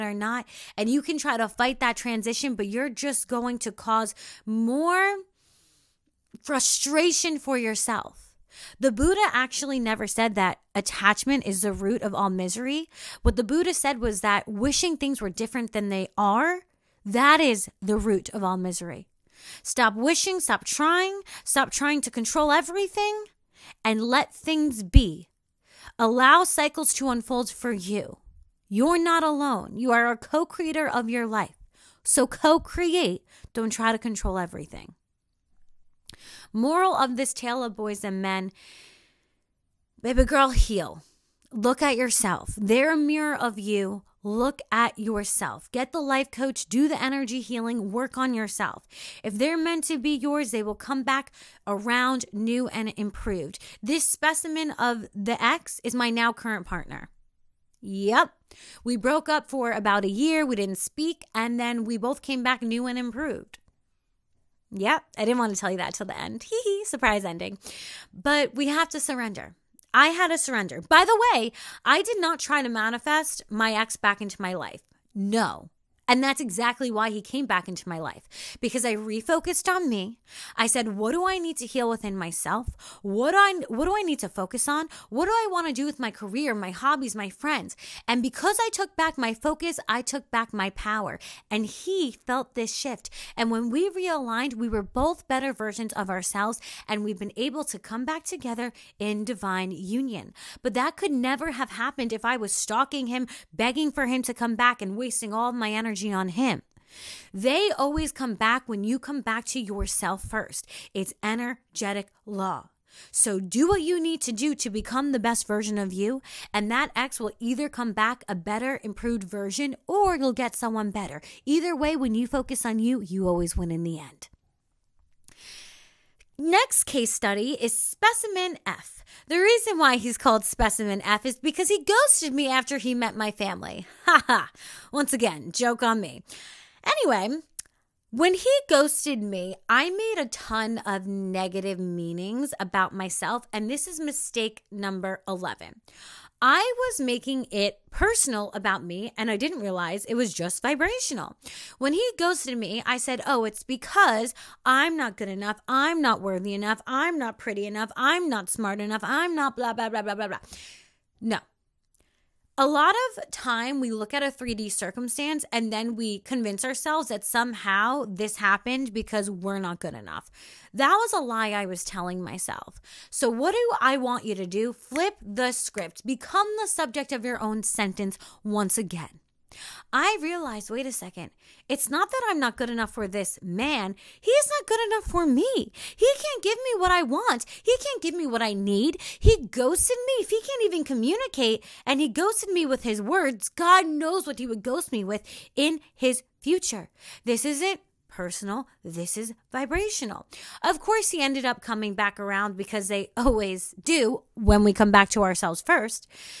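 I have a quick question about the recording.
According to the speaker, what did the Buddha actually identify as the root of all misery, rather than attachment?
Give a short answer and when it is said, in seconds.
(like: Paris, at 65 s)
Wishing things were different, at 14 s.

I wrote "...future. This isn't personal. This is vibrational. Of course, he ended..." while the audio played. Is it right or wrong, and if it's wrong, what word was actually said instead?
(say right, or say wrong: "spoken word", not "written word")
right.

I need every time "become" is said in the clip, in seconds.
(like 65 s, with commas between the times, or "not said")
114 s, 176 s.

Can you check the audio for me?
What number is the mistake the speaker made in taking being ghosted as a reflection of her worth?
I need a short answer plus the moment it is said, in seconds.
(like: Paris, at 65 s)
11, at 143 s.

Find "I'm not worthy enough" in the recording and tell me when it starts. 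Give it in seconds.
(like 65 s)
155 s.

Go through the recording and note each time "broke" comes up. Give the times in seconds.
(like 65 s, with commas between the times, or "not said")
58 s.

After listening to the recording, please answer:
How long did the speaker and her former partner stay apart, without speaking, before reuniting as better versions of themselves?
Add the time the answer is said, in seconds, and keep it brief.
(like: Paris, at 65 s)
About a year, at 59 s.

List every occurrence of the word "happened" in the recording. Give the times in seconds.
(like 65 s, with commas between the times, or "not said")
101 s, 168 s.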